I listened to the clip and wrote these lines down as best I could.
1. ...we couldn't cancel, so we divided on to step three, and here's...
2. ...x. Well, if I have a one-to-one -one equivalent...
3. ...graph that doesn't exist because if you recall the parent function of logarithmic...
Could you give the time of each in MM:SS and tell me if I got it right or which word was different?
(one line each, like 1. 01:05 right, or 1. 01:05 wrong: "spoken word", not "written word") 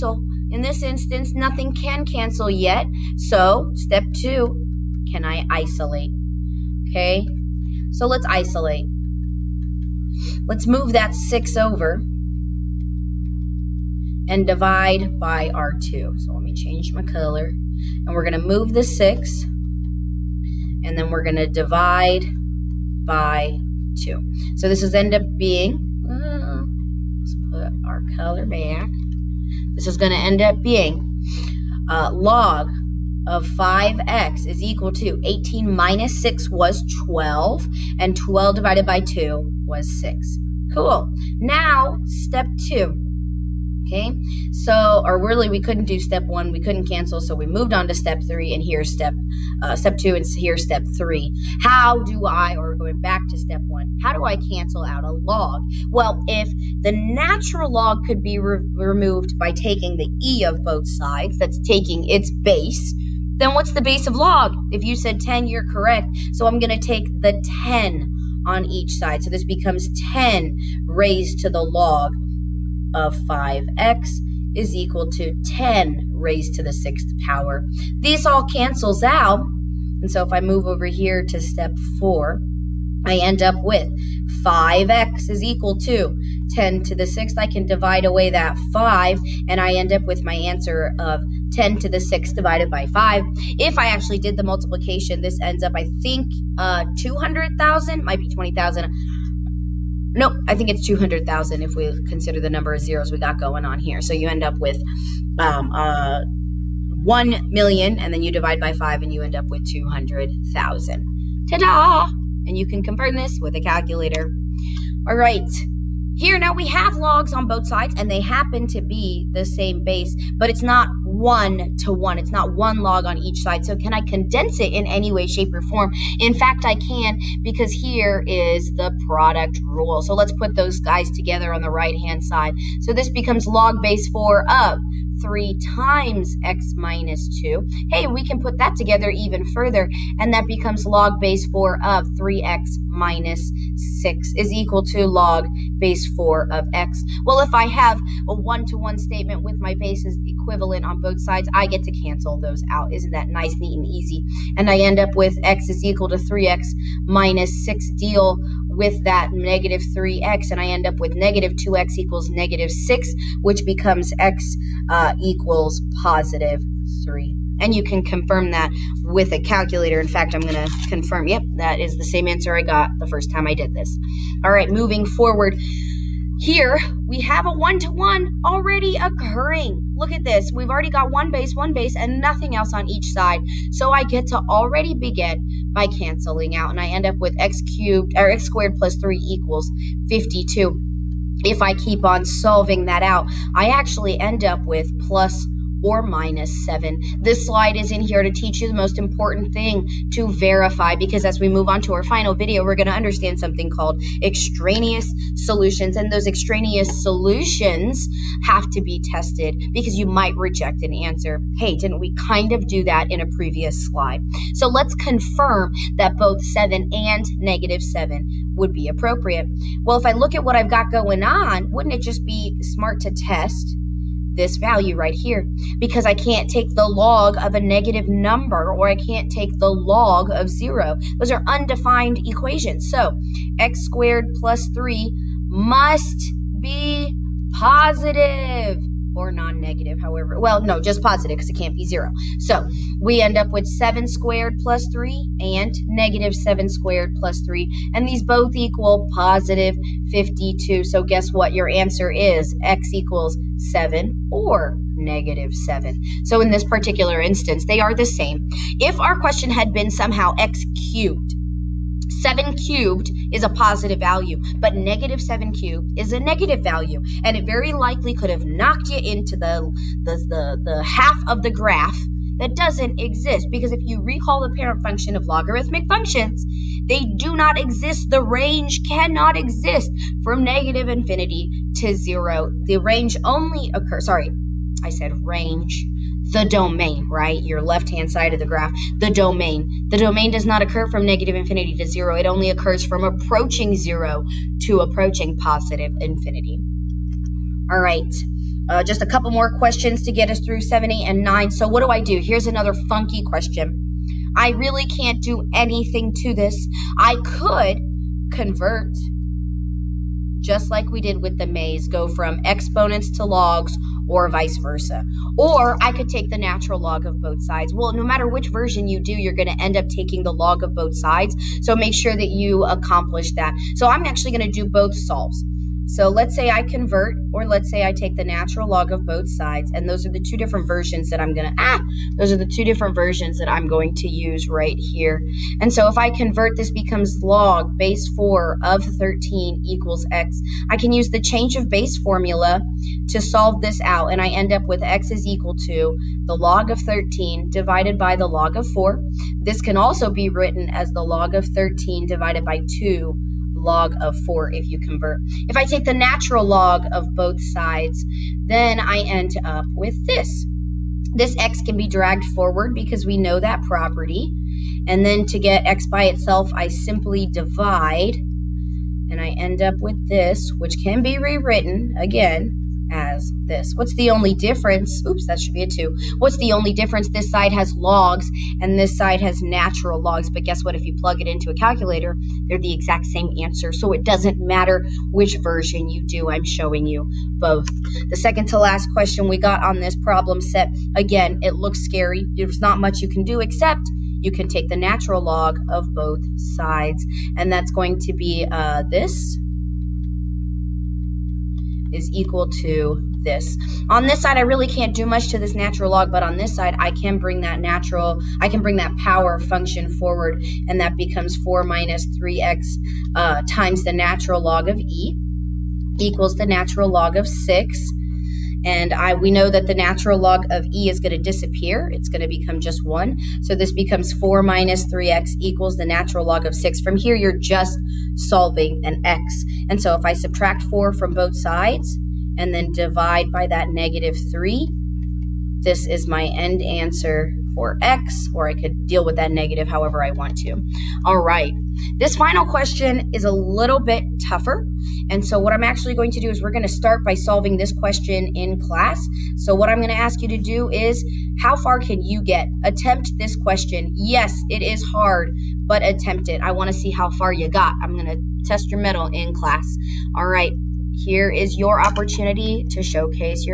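1. 00:46 wrong: "moved", not "divided"
2. 02:26 wrong: "statement", not "equivalent"
3. 04:31 right.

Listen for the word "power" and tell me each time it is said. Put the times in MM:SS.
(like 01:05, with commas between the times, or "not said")
01:17, 06:48.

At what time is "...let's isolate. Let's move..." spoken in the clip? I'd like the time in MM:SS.
00:08.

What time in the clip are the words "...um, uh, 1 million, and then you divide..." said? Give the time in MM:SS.
01:45.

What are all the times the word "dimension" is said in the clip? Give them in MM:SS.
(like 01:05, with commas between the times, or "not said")
not said.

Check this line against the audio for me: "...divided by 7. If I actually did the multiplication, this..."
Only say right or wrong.
wrong.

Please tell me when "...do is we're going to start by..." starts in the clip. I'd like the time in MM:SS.
07:26.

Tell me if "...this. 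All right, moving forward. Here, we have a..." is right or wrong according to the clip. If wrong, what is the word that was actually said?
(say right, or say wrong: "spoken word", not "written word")
right.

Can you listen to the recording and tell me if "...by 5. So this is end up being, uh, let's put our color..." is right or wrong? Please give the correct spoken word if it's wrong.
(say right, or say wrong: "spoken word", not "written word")
wrong: "2", not "5".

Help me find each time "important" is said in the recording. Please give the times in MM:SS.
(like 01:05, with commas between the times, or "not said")
03:18.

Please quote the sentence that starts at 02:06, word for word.
In fact, I can because here is the product rule.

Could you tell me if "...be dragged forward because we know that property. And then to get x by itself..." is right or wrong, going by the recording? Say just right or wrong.
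right.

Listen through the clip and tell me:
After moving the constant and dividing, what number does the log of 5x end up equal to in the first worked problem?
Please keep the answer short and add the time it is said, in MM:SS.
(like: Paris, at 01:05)
6, at 00:38.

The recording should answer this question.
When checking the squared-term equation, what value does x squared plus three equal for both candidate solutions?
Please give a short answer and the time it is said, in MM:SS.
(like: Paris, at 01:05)
52, at 04:09.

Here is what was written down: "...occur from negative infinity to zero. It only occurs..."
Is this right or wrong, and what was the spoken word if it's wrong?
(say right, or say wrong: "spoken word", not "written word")
right.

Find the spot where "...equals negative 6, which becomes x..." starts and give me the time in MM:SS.
02:41.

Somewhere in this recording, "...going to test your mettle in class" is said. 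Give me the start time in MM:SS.
07:37.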